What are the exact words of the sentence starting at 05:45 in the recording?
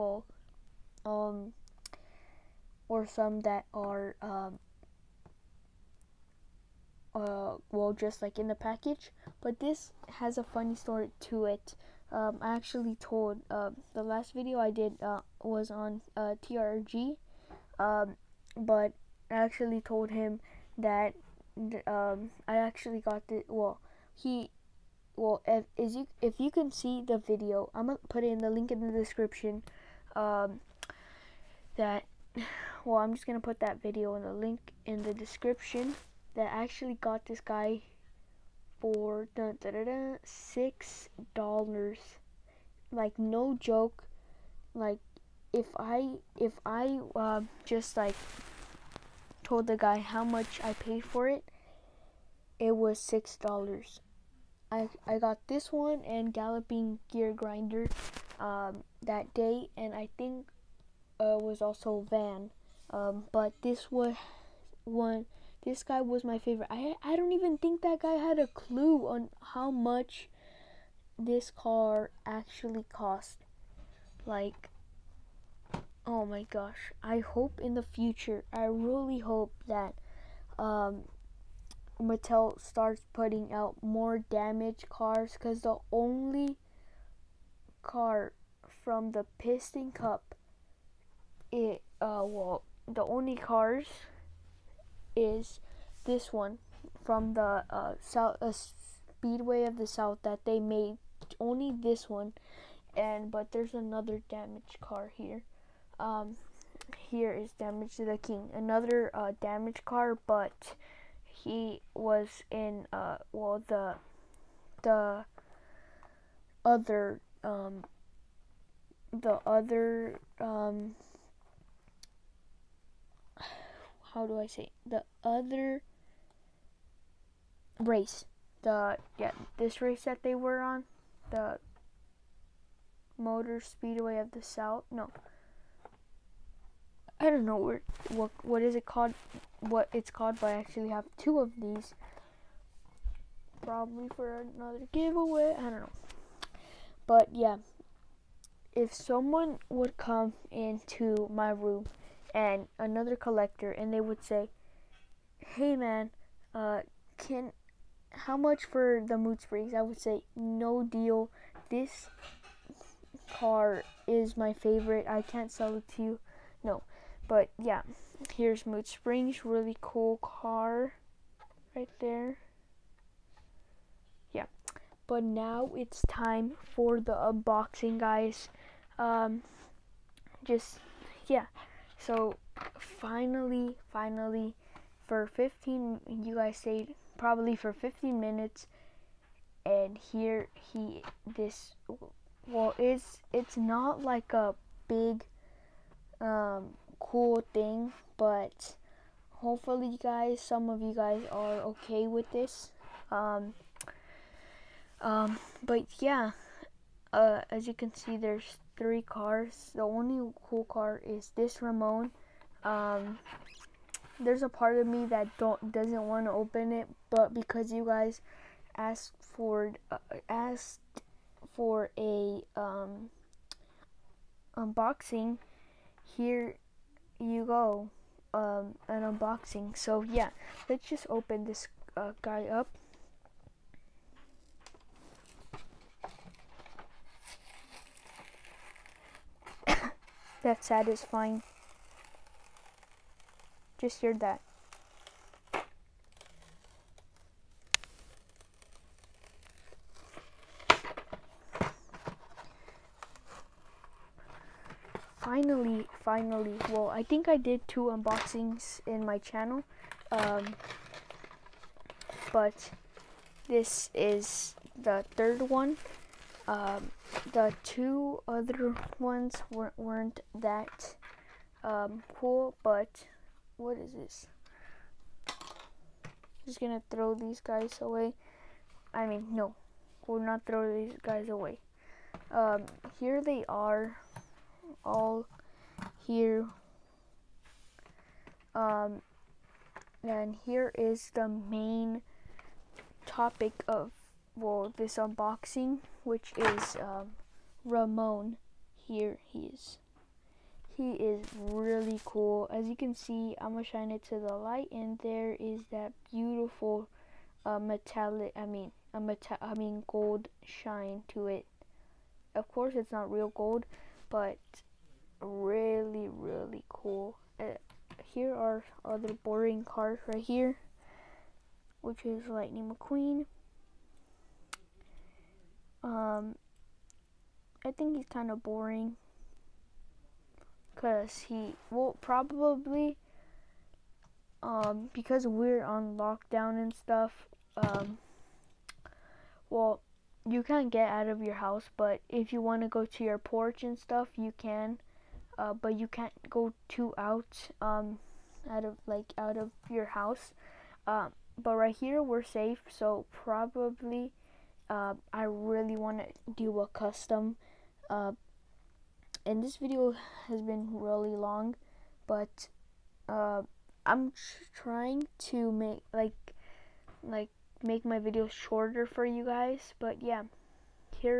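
Uh, but you can't go too out um, out of like out of your house.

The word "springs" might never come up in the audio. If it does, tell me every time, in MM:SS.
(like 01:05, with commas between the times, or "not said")
02:39, 02:48.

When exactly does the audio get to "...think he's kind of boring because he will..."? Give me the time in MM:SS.
05:27.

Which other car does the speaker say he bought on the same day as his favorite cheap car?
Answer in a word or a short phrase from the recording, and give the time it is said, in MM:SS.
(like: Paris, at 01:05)
Galloping Gear Grinder, at 00:56.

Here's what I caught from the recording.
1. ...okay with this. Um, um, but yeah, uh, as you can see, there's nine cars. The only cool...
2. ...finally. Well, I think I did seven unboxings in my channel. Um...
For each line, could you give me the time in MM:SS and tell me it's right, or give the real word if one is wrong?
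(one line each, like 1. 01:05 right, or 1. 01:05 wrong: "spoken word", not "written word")
1. 03:21 wrong: "three", not "nine"
2. 04:16 wrong: "two", not "seven".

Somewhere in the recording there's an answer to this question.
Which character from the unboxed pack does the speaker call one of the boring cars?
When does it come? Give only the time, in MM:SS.
05:22.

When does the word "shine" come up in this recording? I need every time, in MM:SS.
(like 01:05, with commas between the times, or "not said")
05:03, 05:10.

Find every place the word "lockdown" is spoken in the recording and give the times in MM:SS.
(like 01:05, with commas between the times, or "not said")
05:35.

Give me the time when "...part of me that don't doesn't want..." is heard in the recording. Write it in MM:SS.
03:34.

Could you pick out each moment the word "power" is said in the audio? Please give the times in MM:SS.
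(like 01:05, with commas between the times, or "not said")
not said.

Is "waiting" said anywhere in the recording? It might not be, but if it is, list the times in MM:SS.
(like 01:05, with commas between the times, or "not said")
not said.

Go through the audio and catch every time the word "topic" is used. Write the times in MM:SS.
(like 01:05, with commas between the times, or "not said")
04:53.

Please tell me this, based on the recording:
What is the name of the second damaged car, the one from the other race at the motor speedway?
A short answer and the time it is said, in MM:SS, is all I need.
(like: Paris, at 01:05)
Damage to the King, at 01:47.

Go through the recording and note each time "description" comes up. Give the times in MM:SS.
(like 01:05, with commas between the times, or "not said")
00:28, 00:35.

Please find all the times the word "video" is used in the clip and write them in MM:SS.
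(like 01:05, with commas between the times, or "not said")
00:14, 00:27, 00:33, 05:59, 06:07.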